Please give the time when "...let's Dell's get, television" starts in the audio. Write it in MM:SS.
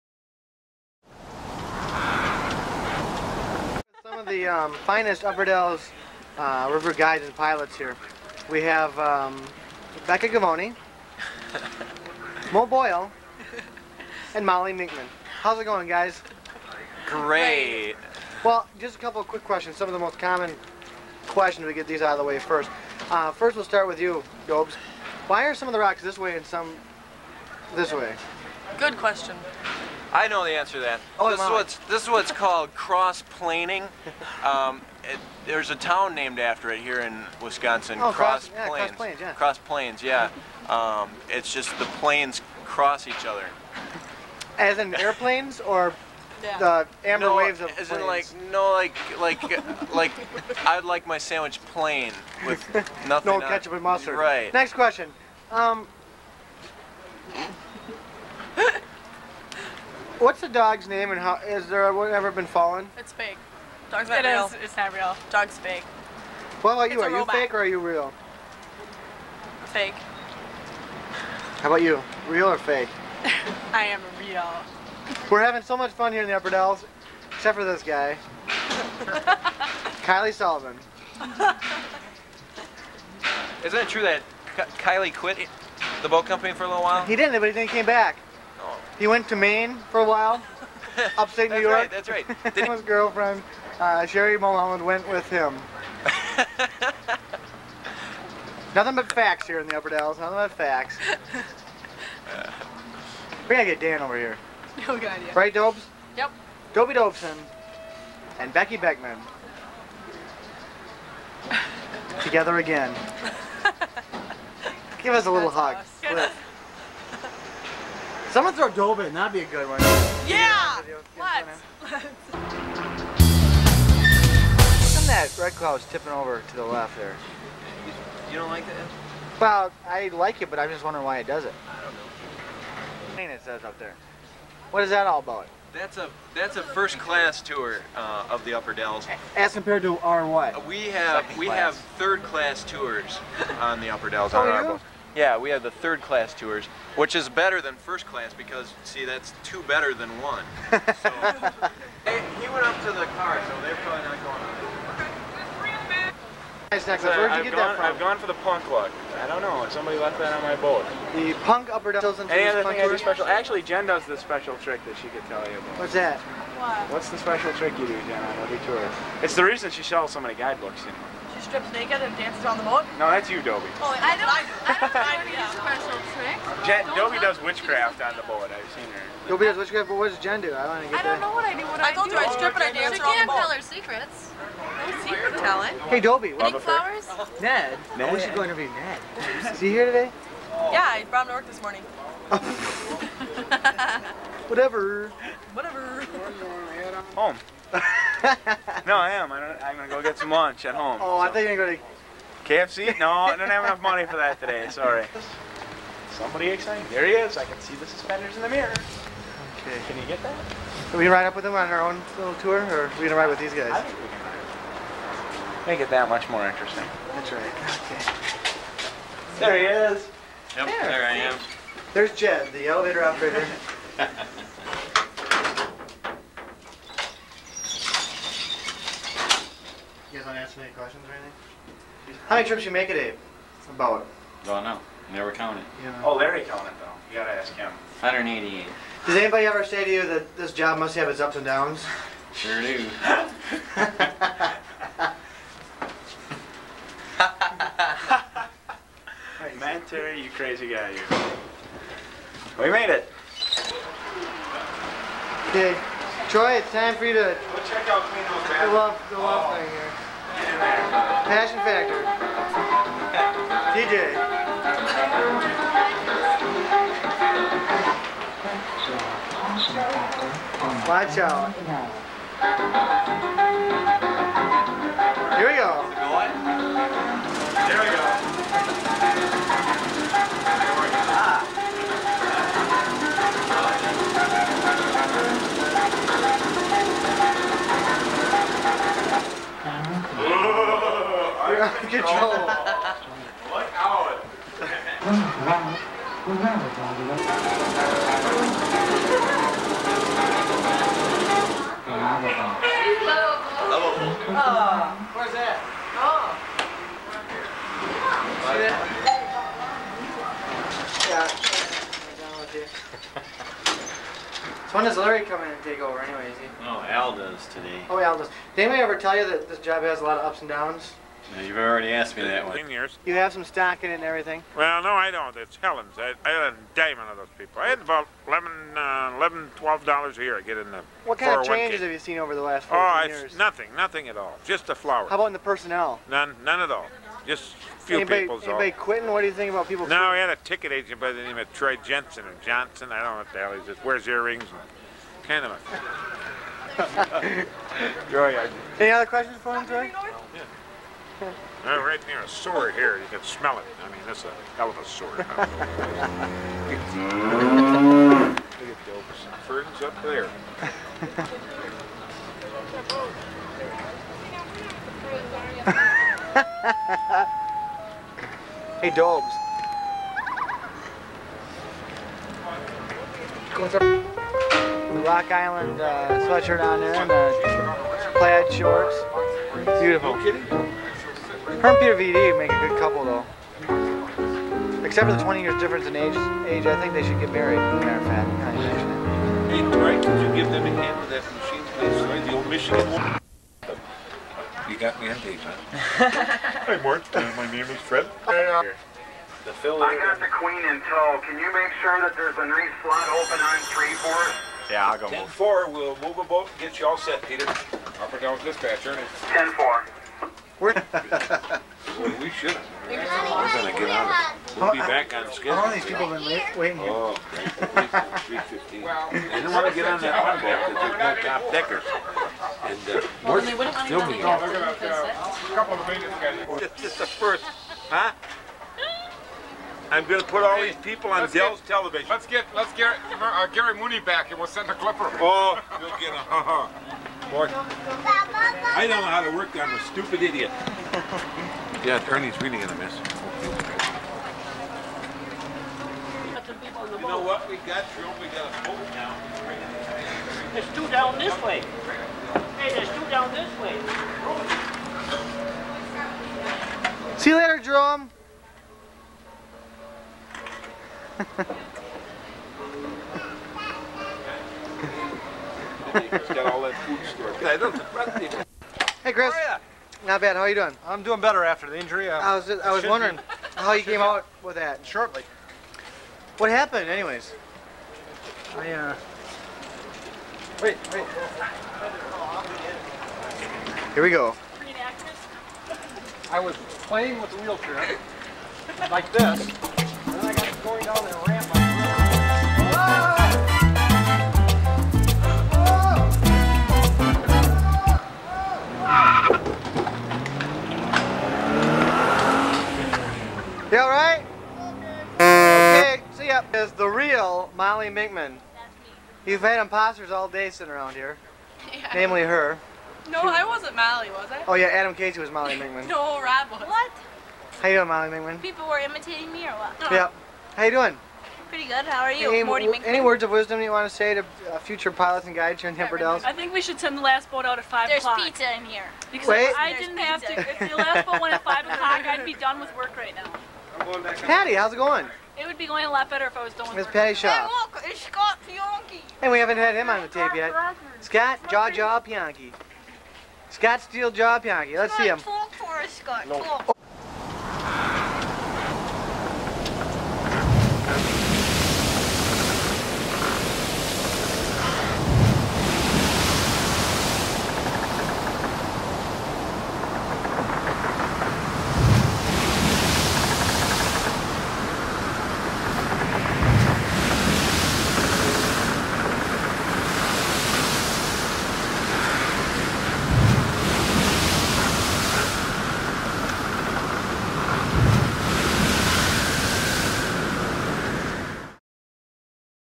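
07:11.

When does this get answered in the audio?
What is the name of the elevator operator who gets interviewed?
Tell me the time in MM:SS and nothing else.
03:42.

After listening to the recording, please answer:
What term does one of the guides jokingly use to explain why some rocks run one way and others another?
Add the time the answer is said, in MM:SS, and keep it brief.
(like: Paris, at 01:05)
cross-planing, at 00:32.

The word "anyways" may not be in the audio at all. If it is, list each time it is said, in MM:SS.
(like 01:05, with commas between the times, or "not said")
05:16, 07:56.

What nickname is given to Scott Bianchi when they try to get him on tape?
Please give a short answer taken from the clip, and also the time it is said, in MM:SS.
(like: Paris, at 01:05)
Steel Jaw, at 09:03.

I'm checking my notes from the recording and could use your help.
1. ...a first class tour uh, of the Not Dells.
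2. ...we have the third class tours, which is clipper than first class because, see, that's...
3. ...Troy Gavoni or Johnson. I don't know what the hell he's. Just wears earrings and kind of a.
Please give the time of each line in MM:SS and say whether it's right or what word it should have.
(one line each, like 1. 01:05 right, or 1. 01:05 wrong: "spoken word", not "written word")
1. 02:16 wrong: "Upper", not "Not"
2. 02:25 wrong: "better", not "clipper"
3. 05:41 wrong: "Jensen", not "Gavoni".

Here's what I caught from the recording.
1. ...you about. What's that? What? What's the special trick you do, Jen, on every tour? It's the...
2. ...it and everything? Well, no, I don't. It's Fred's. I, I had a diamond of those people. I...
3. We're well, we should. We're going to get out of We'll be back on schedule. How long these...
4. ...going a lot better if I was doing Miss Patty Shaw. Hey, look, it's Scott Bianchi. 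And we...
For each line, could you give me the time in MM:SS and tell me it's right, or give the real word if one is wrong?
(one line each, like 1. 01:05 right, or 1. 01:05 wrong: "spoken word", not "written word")
1. 02:45 right
2. 05:23 wrong: "Helen", not "Fred"
3. 06:50 right
4. 08:55 right.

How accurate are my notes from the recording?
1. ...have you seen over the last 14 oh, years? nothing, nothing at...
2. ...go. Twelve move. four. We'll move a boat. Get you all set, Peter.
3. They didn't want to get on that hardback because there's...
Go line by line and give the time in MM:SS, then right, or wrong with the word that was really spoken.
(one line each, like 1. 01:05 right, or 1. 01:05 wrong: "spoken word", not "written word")
1. 05:31 right
2. 06:44 wrong: "Ten", not "Twelve"
3. 06:58 right.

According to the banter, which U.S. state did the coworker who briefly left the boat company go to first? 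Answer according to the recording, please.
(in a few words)
Maine.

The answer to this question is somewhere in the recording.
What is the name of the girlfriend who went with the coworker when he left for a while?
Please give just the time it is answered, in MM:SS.
01:34.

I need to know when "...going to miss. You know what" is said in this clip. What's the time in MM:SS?
07:22.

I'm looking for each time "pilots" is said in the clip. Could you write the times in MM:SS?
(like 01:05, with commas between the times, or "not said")
00:07, 08:44.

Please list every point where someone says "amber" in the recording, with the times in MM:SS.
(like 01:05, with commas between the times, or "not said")
00:47.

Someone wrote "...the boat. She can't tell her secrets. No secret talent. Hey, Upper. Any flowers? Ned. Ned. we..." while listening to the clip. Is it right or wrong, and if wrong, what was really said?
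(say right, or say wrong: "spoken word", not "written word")
wrong: "Dobie", not "Upper".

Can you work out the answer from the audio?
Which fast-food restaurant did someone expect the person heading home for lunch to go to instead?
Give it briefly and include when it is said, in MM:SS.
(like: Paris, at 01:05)
KFC, at 03:22.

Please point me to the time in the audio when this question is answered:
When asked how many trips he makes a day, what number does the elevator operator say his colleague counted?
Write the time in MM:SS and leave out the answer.
03:58.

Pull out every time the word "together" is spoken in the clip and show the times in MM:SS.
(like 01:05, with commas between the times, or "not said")
01:52.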